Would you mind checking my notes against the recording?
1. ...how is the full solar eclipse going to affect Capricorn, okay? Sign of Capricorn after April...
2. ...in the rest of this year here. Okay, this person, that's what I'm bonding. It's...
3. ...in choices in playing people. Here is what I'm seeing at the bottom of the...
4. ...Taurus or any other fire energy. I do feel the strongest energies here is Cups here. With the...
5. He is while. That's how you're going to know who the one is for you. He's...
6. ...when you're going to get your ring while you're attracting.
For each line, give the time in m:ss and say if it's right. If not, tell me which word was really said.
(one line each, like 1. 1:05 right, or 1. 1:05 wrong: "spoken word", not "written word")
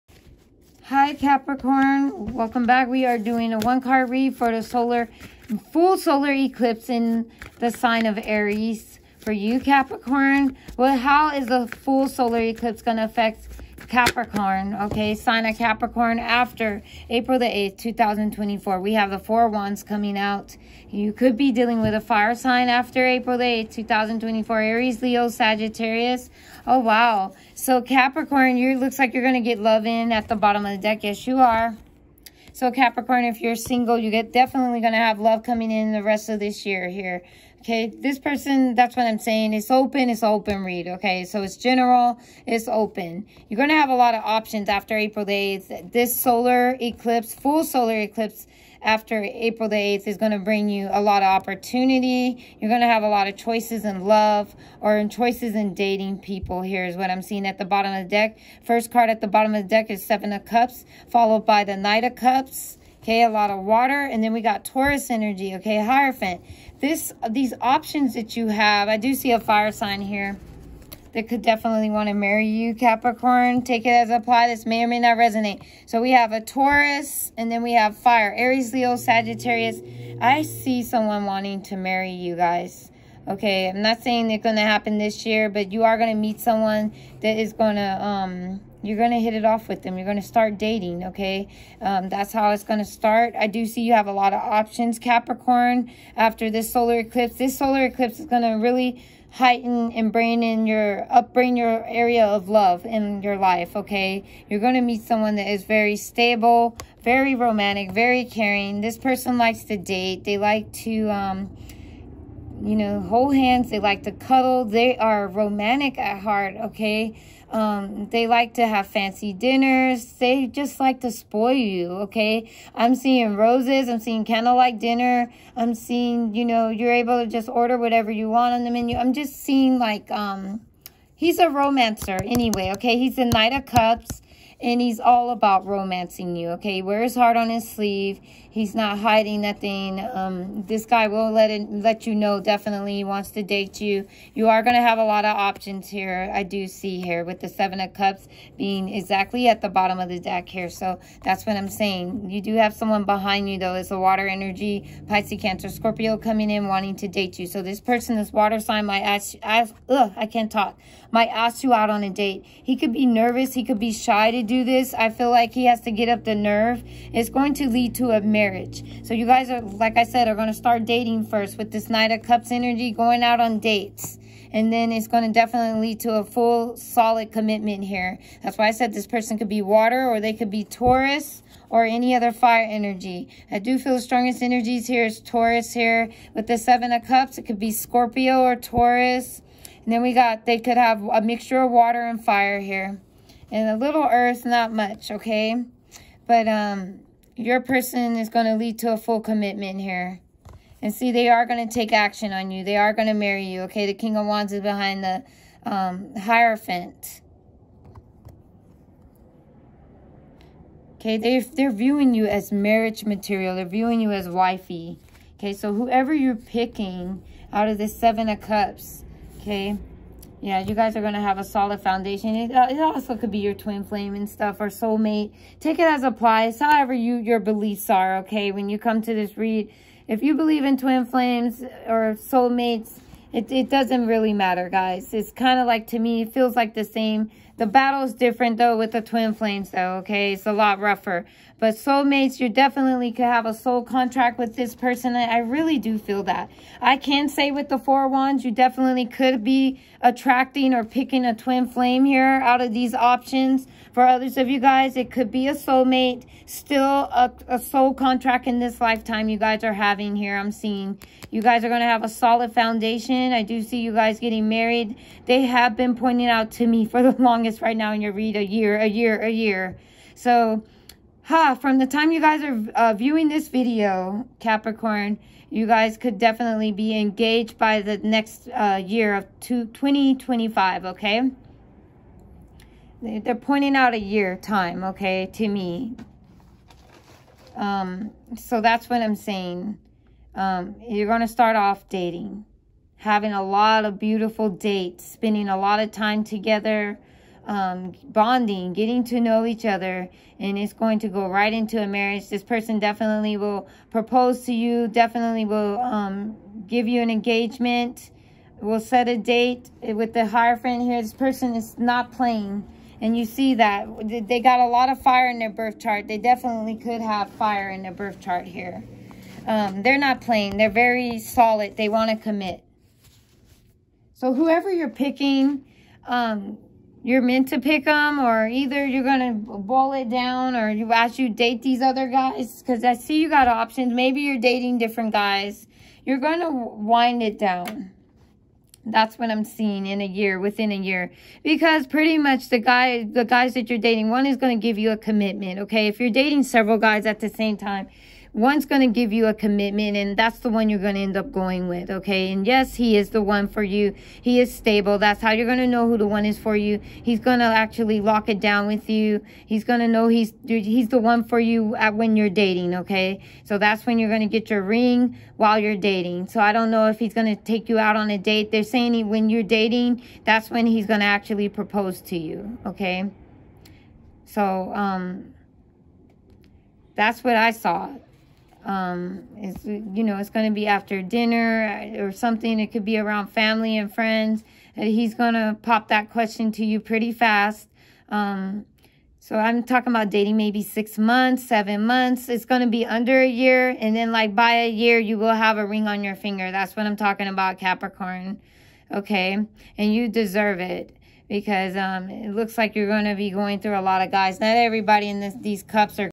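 1. 0:10 right
2. 0:35 wrong: "saying", not "bonding"
3. 0:54 wrong: "dating", not "playing"
4. 3:00 wrong: "Taurus", not "Cups"
5. 5:54 wrong: "stable", not "while"
6. 6:03 wrong: "dating", not "attracting".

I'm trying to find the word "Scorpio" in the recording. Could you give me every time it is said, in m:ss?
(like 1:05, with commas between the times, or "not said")
2:35, 3:07.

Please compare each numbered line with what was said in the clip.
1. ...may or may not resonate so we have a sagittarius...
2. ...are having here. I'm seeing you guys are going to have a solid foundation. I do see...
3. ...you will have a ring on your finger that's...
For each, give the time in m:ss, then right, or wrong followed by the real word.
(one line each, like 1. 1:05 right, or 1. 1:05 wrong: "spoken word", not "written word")
1. 1:14 wrong: "taurus", not "sagittarius"
2. 4:19 right
3. 6:34 right.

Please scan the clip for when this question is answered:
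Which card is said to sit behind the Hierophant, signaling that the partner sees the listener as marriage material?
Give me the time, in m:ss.
3:23.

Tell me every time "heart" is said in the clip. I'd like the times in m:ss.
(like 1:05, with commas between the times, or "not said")
1:56, 2:17.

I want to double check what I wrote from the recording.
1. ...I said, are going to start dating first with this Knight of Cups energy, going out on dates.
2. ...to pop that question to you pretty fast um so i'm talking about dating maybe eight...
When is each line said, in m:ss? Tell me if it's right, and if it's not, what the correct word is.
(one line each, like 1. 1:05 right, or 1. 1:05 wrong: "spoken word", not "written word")
1. 2:49 right
2. 6:25 wrong: "six", not "eight".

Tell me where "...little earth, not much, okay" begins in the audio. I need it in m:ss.
3:13.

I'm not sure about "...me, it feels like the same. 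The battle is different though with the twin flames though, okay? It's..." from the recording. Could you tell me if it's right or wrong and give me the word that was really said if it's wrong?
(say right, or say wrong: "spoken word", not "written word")
right.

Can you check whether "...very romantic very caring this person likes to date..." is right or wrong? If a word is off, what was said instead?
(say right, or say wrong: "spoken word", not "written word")
right.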